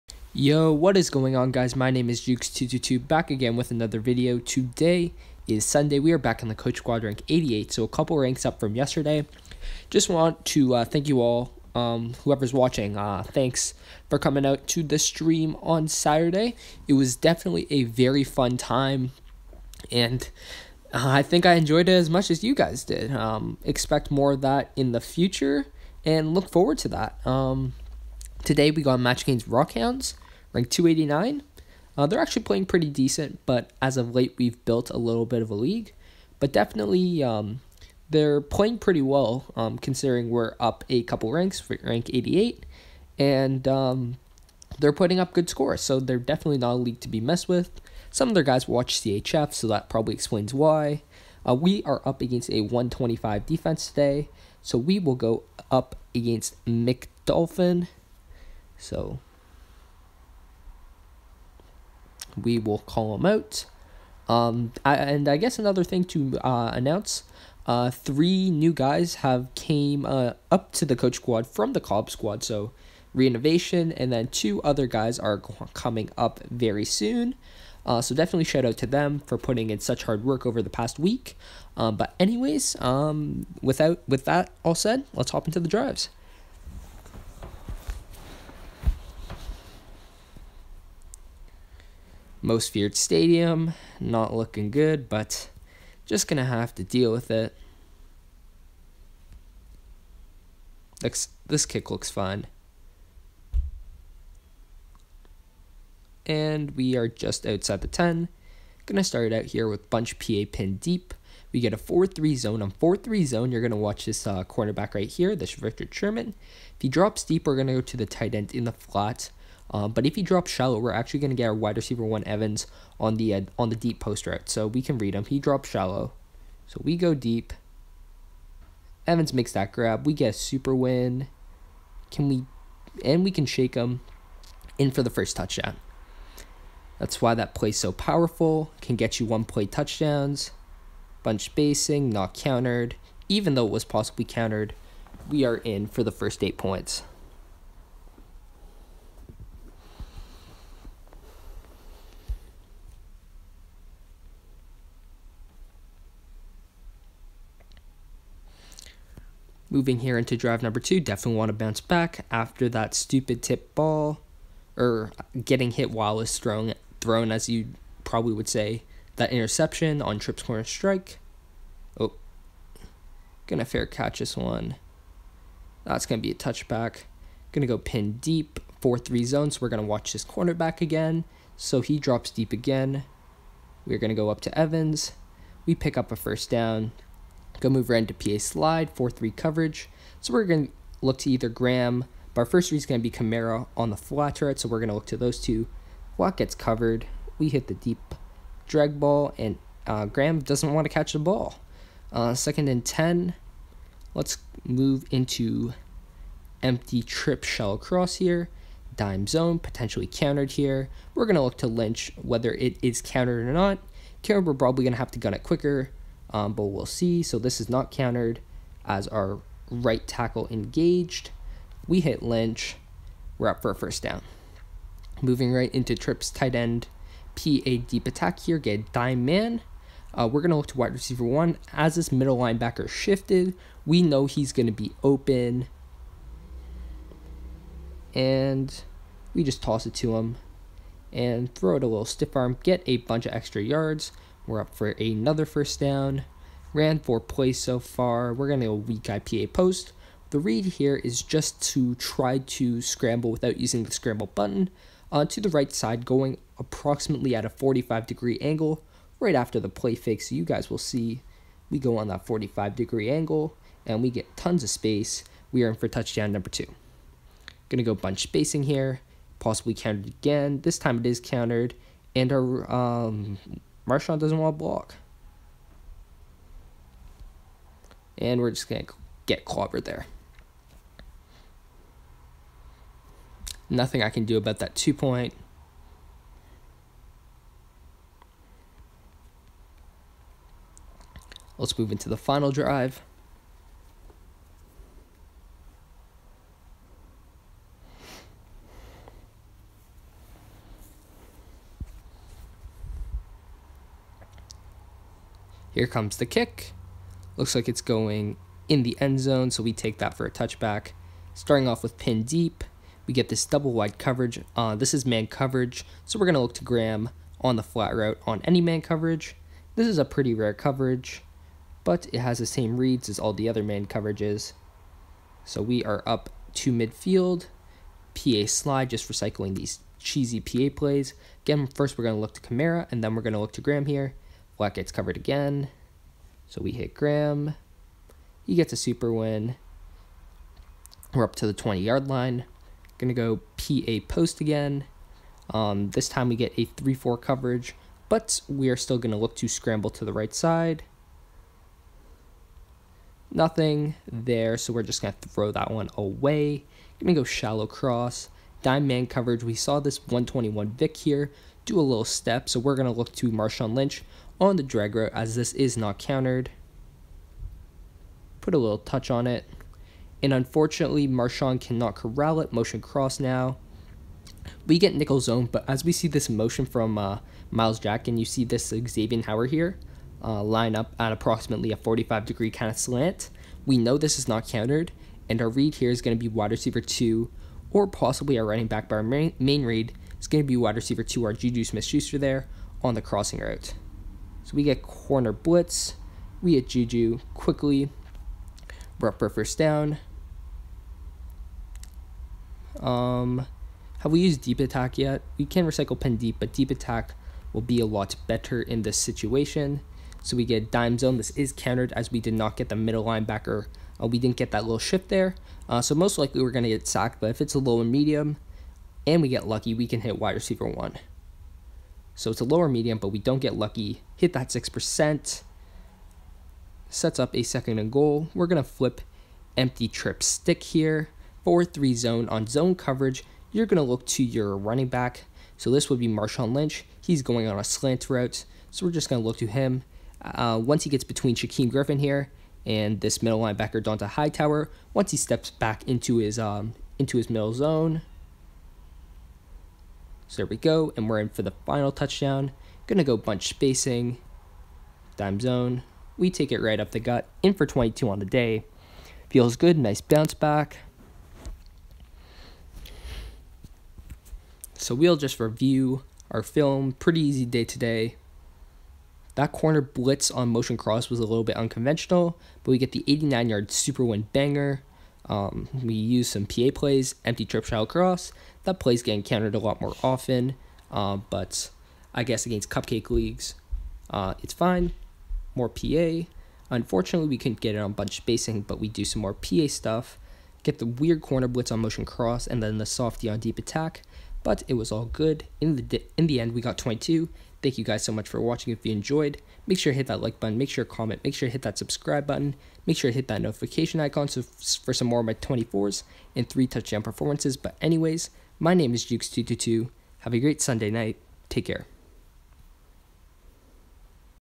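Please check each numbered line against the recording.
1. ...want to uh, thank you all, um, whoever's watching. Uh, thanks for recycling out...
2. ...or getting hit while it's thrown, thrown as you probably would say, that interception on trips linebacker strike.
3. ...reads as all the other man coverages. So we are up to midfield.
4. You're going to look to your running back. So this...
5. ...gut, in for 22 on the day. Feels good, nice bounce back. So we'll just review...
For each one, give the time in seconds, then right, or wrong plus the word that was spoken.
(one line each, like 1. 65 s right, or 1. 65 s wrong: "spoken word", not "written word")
1. 10 s wrong: "coming", not "recycling"
2. 164 s wrong: "corner", not "linebacker"
3. 322 s right
4. 433 s right
5. 457 s right.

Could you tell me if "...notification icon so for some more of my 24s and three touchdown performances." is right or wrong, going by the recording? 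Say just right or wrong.
right.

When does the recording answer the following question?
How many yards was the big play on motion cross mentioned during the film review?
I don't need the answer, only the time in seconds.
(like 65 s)
473 s.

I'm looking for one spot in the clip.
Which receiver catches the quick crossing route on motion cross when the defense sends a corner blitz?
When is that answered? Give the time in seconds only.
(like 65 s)
391 s.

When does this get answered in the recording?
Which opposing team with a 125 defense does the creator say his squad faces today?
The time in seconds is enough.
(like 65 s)
56 s.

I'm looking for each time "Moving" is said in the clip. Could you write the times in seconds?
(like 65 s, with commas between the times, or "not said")
159 s, 225 s.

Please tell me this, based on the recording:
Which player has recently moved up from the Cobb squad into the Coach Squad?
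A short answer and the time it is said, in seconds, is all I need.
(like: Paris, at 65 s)
reinnovation, at 73 s.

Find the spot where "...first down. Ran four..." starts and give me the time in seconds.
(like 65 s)
245 s.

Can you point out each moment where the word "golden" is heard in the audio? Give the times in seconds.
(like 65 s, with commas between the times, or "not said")
not said.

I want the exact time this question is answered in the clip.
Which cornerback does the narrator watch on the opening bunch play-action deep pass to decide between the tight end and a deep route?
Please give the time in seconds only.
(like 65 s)
115 s.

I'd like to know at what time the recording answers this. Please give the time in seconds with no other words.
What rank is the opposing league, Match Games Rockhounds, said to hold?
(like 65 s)
30 s.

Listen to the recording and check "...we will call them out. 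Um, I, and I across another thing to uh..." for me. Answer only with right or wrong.
wrong.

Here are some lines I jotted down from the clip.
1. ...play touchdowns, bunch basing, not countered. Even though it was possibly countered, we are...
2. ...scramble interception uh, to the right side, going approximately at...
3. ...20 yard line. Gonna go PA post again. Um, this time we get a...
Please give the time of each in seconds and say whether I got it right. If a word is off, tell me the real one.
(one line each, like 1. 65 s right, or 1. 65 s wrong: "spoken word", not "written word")
1. 139 s right
2. 253 s wrong: "button", not "interception"
3. 341 s right.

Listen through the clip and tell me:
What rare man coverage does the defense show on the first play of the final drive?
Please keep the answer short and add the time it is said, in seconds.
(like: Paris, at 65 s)
double wide, at 313 s.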